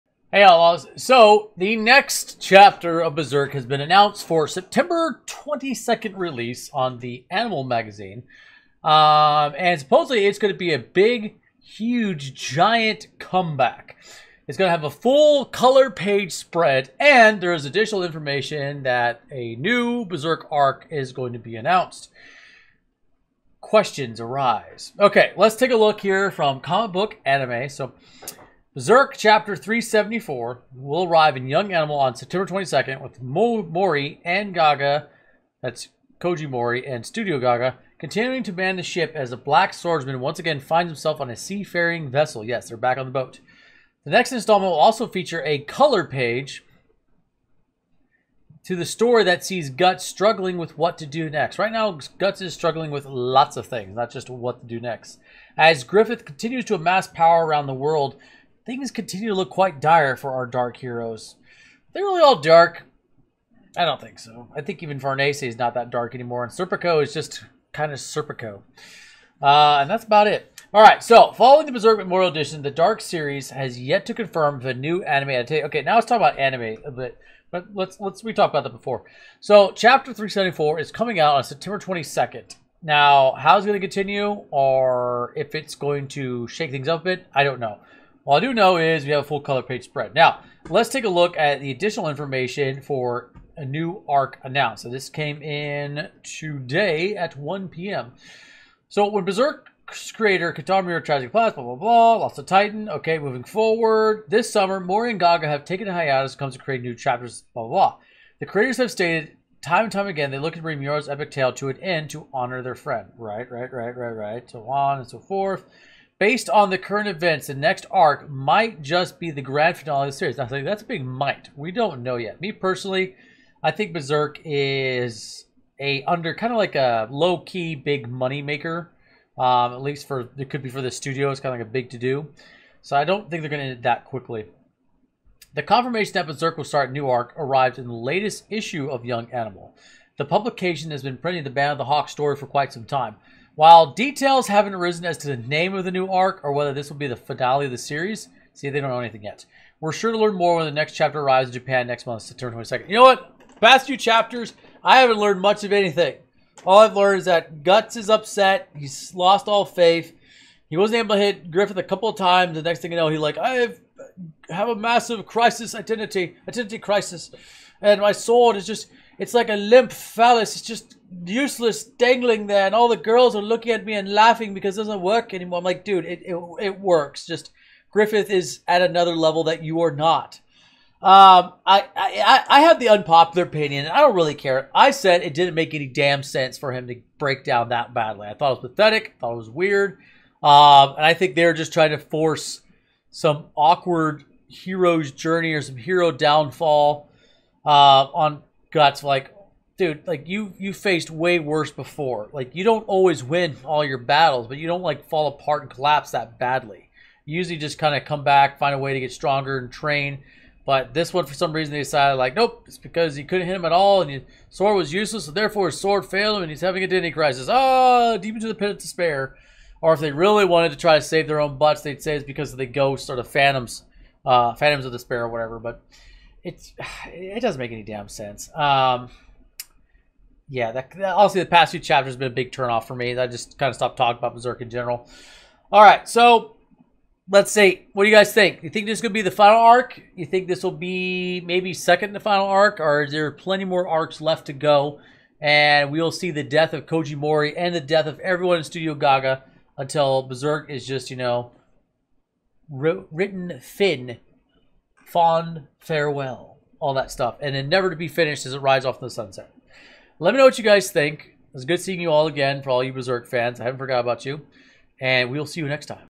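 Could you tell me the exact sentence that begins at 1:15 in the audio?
Okay, now let's talk about anime a bit, but let's let's we talked about that before.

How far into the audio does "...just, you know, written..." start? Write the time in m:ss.
4:10.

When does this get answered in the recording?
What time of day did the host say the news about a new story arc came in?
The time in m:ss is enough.
1:37.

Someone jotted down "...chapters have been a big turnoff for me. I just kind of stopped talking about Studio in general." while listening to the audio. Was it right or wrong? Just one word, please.
wrong.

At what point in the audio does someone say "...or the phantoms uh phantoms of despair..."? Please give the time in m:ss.
3:43.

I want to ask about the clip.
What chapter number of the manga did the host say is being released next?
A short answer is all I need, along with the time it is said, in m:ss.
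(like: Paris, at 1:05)
374, at 0:29.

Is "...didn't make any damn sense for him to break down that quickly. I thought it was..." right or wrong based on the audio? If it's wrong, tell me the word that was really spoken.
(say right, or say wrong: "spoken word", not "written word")
wrong: "badly", not "quickly".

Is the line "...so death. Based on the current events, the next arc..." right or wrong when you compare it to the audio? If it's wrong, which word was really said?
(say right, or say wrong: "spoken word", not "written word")
wrong: "forth", not "death".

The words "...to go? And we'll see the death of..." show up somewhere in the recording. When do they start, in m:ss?
4:04.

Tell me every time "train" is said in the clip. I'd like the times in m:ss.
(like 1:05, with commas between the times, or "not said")
3:29.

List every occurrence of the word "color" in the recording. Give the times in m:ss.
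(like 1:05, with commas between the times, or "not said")
0:15, 0:45, 1:29.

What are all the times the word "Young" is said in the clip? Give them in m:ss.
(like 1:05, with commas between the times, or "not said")
0:31, 2:19.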